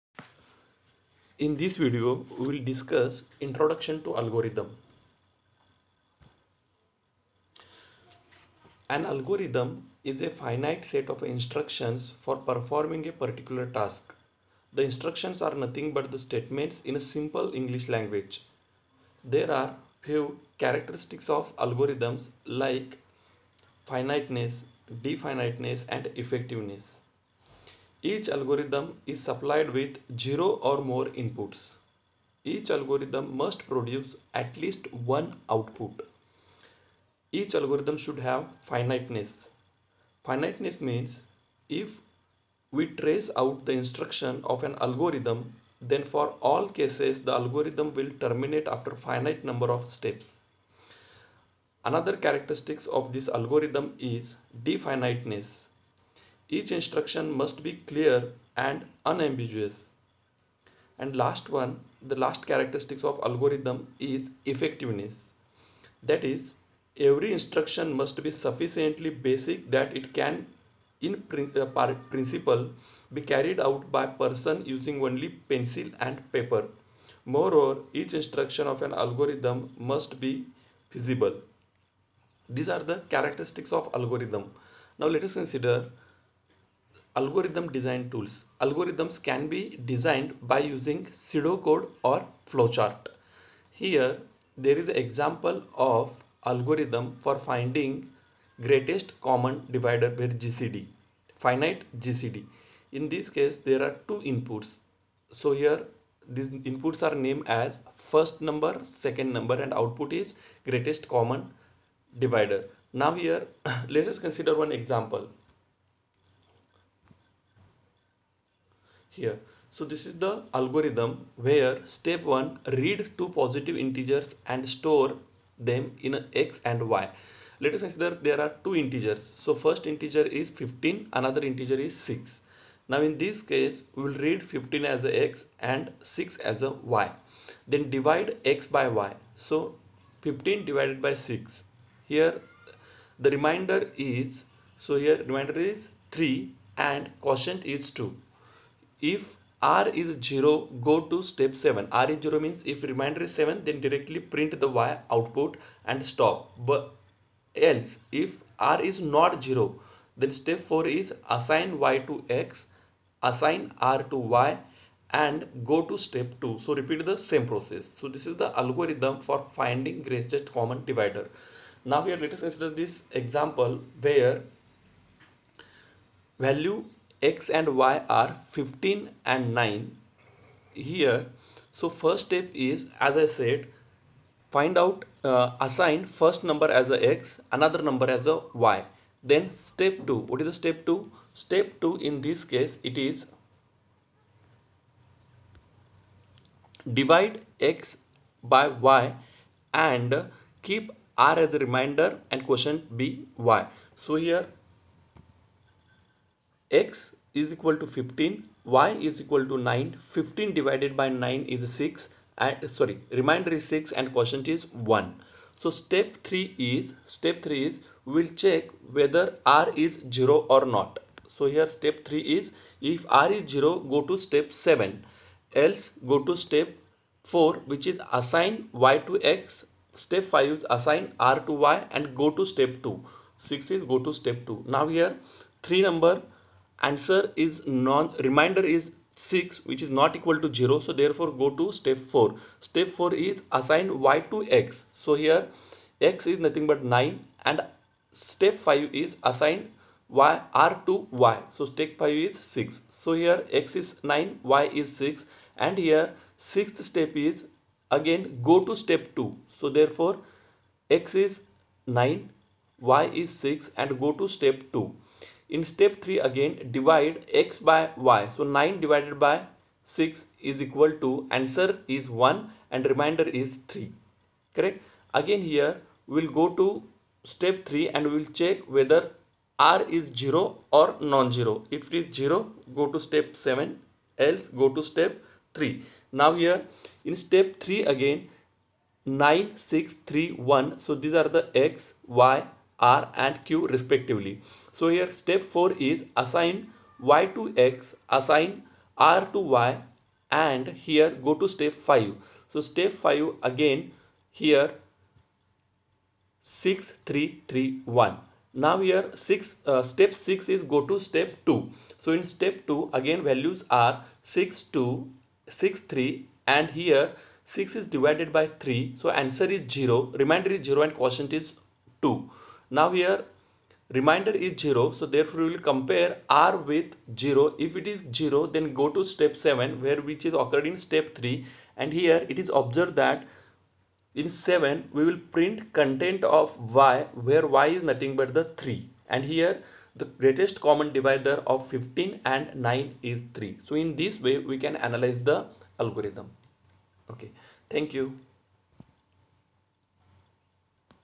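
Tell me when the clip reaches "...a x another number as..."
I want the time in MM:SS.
03:06.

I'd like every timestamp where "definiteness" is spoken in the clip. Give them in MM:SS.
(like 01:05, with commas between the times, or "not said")
00:25, 00:54.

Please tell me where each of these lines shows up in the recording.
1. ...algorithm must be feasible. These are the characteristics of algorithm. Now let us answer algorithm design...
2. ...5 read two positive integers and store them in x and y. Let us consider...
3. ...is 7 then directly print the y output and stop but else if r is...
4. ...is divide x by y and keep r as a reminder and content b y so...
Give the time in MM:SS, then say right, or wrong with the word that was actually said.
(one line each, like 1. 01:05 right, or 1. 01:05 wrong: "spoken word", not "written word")
1. 01:18 wrong: "consider", not "answer"
2. 02:02 wrong: "1", not "5"
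3. 02:33 right
4. 03:12 wrong: "quotient", not "content".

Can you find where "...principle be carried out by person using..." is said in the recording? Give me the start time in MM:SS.
01:12.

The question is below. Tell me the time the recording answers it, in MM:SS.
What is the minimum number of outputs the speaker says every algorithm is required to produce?
00:34.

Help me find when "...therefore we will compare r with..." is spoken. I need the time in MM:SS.
05:25.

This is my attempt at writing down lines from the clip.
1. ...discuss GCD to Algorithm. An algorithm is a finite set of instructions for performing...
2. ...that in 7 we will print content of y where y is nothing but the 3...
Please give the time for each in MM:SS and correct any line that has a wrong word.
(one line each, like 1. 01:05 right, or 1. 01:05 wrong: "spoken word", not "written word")
1. 00:02 wrong: "Introduction", not "GCD"
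2. 05:33 right.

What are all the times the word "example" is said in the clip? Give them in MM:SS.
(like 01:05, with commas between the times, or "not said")
01:34, 01:54, 02:53.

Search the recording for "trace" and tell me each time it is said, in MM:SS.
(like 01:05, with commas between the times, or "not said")
00:42.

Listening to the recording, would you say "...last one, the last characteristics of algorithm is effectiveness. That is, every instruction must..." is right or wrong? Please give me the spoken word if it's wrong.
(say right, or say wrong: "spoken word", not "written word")
right.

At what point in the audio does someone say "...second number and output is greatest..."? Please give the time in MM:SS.
01:48.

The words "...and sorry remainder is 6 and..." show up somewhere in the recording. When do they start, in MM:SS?
03:32.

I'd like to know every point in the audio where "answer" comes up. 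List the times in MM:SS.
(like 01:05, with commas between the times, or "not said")
03:56, 04:31, 05:19.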